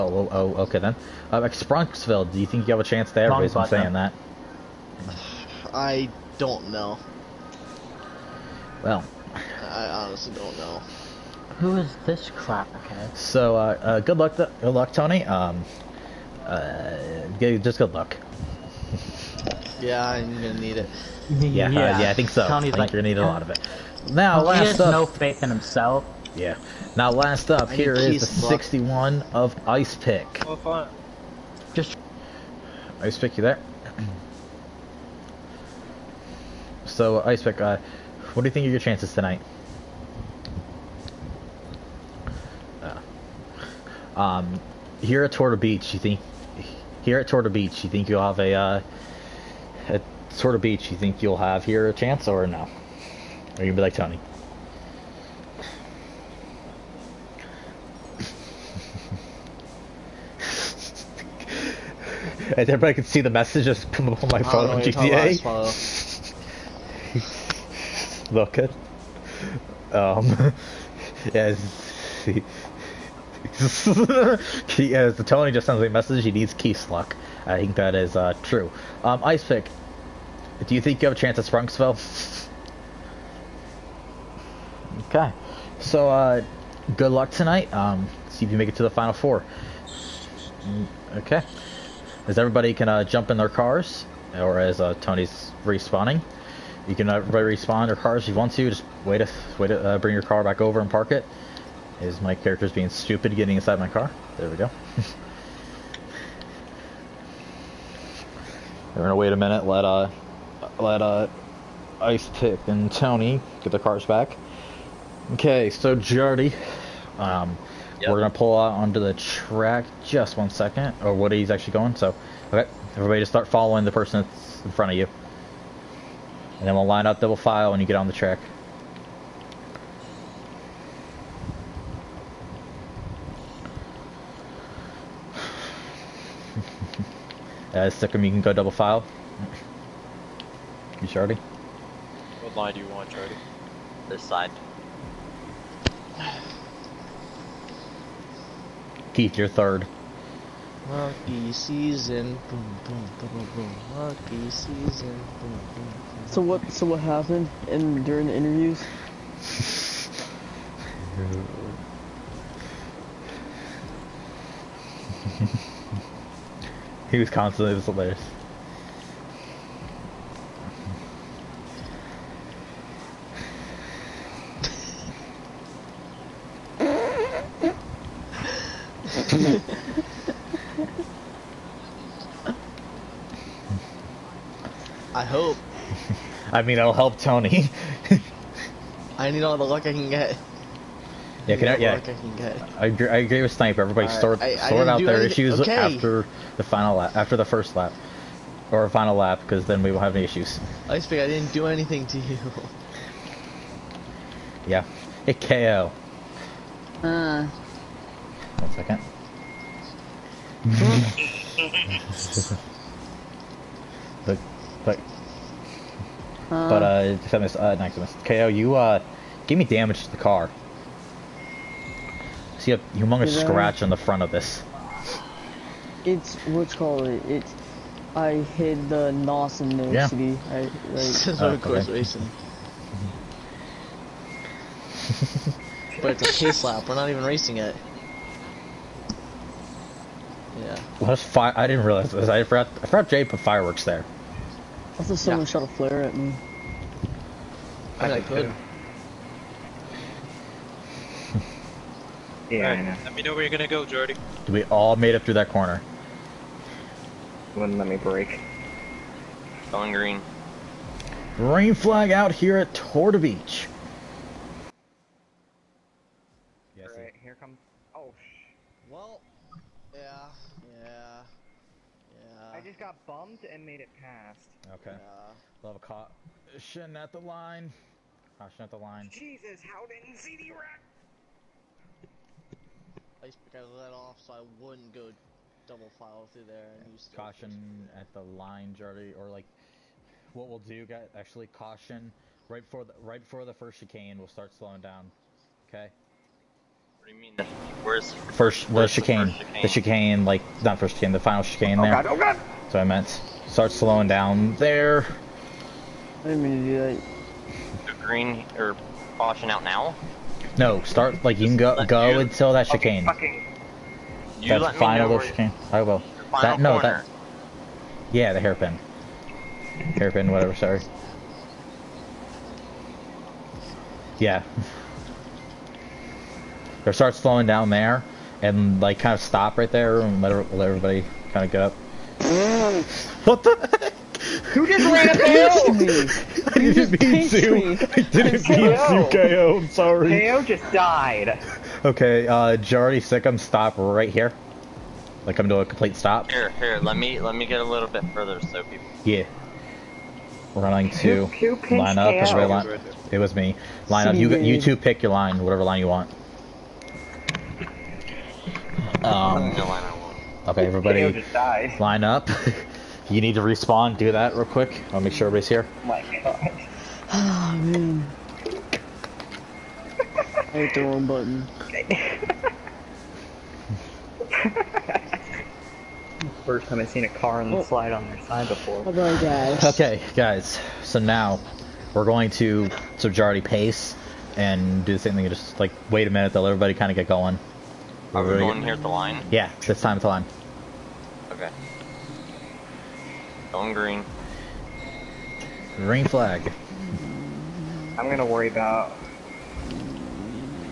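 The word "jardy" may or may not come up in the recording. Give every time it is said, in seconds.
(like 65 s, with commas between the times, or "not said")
115 s, 288 s, 382 s.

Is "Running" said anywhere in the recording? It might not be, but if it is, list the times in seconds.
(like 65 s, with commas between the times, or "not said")
350 s.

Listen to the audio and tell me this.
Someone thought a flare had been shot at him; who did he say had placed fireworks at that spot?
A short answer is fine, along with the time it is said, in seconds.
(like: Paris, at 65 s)
Jay, at 243 s.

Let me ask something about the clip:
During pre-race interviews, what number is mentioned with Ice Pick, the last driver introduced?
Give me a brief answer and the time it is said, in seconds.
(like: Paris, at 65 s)
61, at 28 s.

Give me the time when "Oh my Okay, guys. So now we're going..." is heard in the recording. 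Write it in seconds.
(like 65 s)
378 s.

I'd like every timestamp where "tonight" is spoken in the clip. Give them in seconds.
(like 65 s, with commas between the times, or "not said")
39 s, 87 s.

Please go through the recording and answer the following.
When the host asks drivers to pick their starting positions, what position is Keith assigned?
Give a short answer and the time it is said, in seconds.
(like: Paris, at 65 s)
third, at 149 s.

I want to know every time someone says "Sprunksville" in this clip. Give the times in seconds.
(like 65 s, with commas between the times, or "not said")
1 s, 81 s.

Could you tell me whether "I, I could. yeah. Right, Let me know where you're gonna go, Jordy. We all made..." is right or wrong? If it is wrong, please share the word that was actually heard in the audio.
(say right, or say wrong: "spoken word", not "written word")
right.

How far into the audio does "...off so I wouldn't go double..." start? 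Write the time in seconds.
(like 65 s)
283 s.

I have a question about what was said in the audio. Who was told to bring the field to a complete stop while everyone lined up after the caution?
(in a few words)
Jari Sikkim.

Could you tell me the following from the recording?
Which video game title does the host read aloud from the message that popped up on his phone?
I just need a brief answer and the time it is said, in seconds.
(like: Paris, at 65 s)
GTA, at 64 s.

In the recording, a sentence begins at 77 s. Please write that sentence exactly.
I think that is uh, true.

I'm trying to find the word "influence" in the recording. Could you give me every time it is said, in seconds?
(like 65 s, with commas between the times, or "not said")
not said.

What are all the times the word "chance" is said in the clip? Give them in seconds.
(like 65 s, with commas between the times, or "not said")
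2 s, 38 s, 51 s, 81 s.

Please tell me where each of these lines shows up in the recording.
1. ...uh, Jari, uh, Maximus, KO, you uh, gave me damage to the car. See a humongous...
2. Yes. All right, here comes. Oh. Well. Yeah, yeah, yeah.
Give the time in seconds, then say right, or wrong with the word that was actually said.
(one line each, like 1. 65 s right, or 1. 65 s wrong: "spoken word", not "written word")
1. 216 s wrong: "Maximus", not "Jari"
2. 266 s right.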